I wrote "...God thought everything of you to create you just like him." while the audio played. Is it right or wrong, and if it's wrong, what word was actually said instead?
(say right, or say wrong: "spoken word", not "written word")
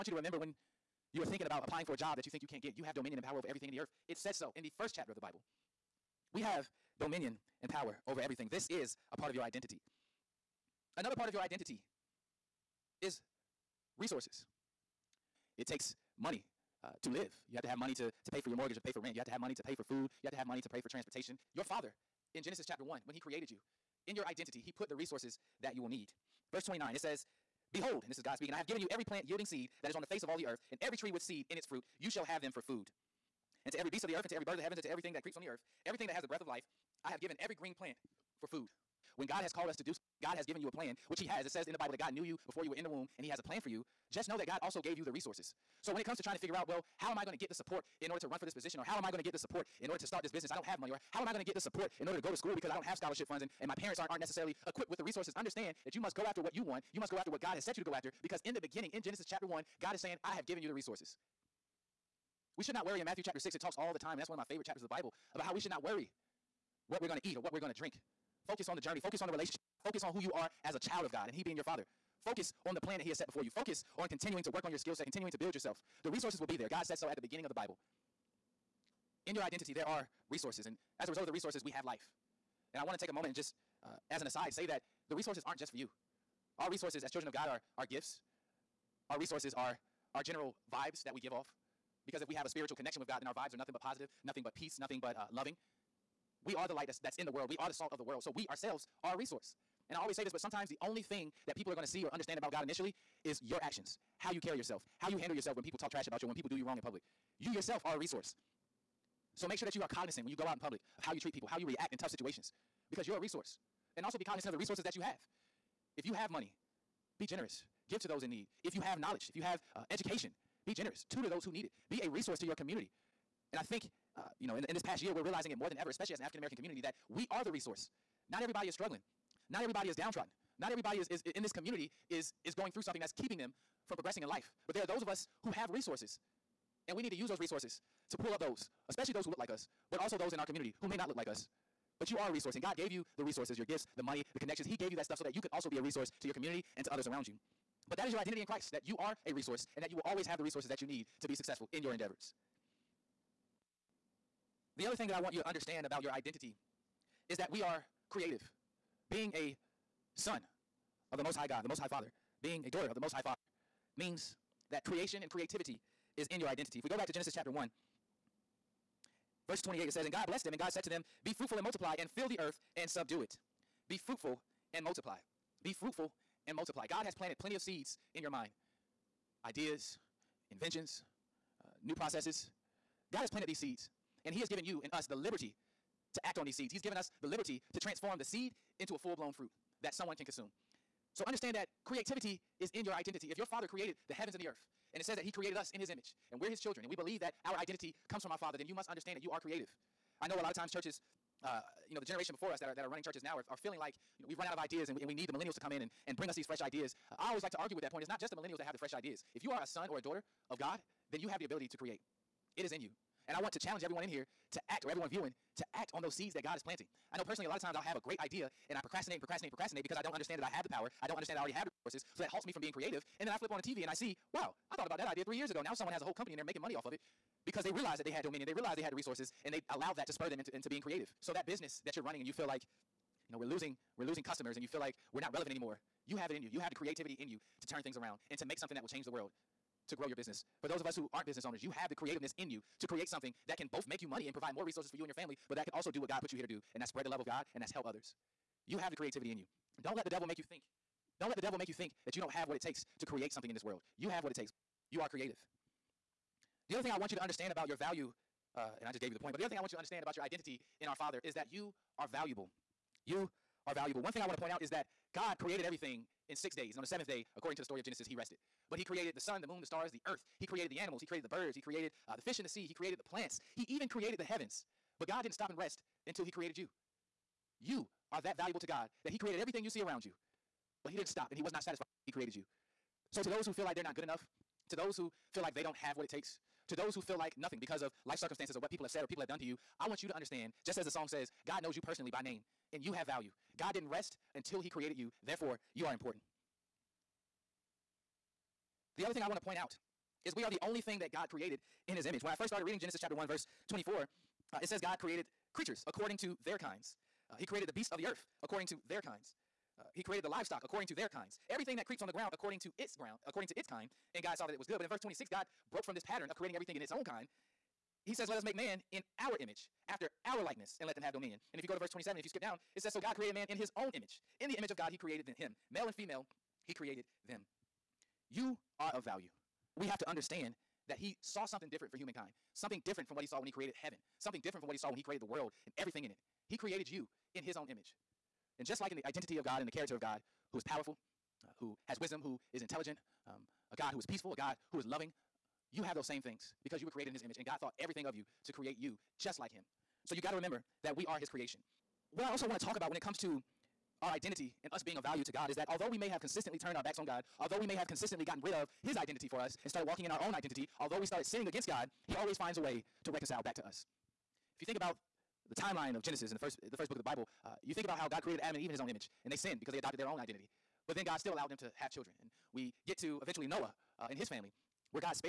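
right.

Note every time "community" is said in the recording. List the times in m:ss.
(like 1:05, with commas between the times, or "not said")
2:02, 2:06, 2:11, 2:20, 2:26.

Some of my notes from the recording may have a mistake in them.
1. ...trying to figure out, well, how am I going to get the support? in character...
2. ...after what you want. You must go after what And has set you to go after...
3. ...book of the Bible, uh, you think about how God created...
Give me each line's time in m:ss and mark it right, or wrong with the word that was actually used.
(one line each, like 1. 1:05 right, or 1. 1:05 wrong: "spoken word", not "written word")
1. 0:46 wrong: "order", not "character"
2. 0:56 wrong: "God", not "And"
3. 6:06 right.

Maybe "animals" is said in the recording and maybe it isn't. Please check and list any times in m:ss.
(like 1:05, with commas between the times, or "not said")
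4:30.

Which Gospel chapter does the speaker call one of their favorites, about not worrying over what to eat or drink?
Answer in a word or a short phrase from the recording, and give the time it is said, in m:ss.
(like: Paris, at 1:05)
Matthew chapter 6, at 1:03.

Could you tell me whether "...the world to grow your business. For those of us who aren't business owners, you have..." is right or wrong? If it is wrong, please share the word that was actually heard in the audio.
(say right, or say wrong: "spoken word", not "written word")
right.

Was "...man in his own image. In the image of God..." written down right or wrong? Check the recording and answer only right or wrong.
right.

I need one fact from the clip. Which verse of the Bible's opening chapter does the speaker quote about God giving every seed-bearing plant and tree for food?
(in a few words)
Verse 29.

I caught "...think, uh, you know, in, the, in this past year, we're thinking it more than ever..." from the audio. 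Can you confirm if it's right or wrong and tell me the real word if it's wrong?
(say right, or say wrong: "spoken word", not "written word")
wrong: "realizing", not "thinking".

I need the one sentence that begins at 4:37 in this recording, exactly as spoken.
You are that valuable to God that He created everything you see around you.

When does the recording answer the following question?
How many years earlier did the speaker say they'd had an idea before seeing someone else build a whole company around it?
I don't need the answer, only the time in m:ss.
3:45.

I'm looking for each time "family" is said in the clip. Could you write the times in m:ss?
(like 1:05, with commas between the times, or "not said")
4:05, 6:14.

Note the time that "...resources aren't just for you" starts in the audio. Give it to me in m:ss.
1:25.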